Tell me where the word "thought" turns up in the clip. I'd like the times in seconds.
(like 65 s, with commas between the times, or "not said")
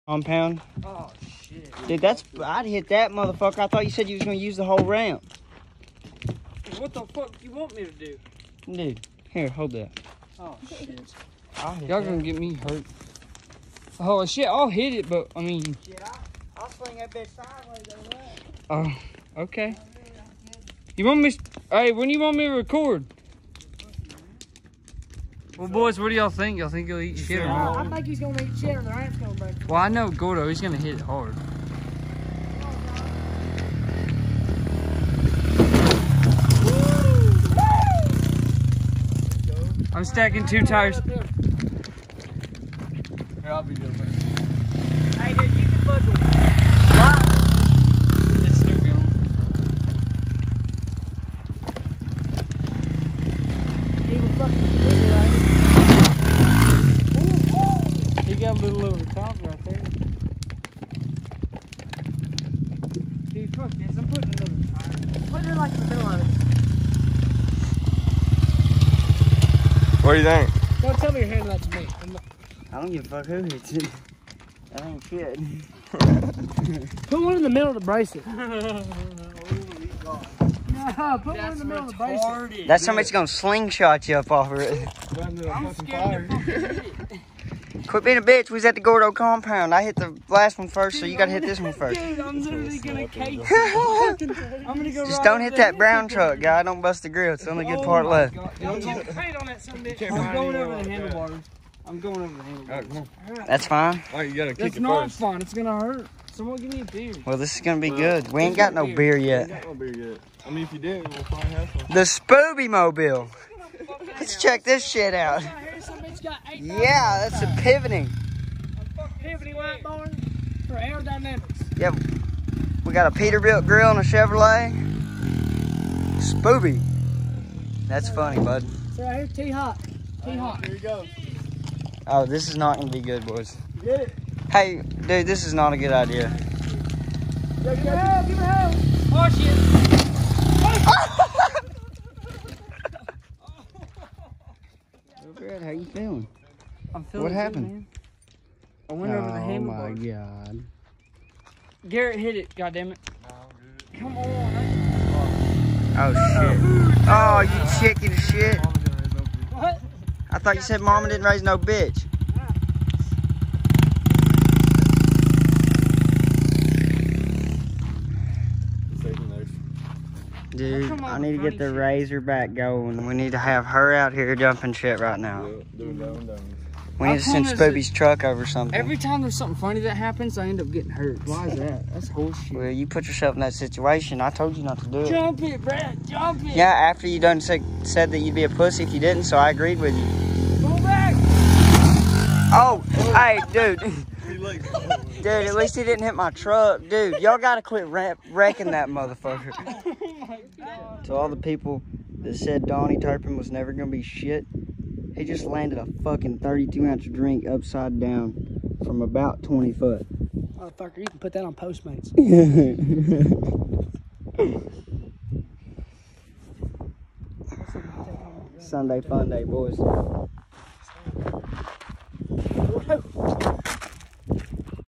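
3 s, 160 s.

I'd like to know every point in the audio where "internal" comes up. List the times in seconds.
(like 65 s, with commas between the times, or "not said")
not said.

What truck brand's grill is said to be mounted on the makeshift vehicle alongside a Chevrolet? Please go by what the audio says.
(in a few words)
Peterbilt.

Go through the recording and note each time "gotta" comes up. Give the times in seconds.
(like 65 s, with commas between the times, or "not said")
91 s, 104 s.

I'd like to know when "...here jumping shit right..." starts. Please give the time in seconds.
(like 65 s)
174 s.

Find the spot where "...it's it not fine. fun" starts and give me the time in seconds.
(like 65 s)
104 s.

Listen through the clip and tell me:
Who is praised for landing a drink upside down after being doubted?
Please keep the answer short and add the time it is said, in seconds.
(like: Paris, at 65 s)
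Donnie Turpin, at 202 s.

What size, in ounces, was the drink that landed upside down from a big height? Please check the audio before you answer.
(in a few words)
32.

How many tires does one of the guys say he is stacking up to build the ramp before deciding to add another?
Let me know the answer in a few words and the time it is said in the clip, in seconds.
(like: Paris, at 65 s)
2, at 40 s.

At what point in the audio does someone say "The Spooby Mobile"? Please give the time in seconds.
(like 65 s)
111 s.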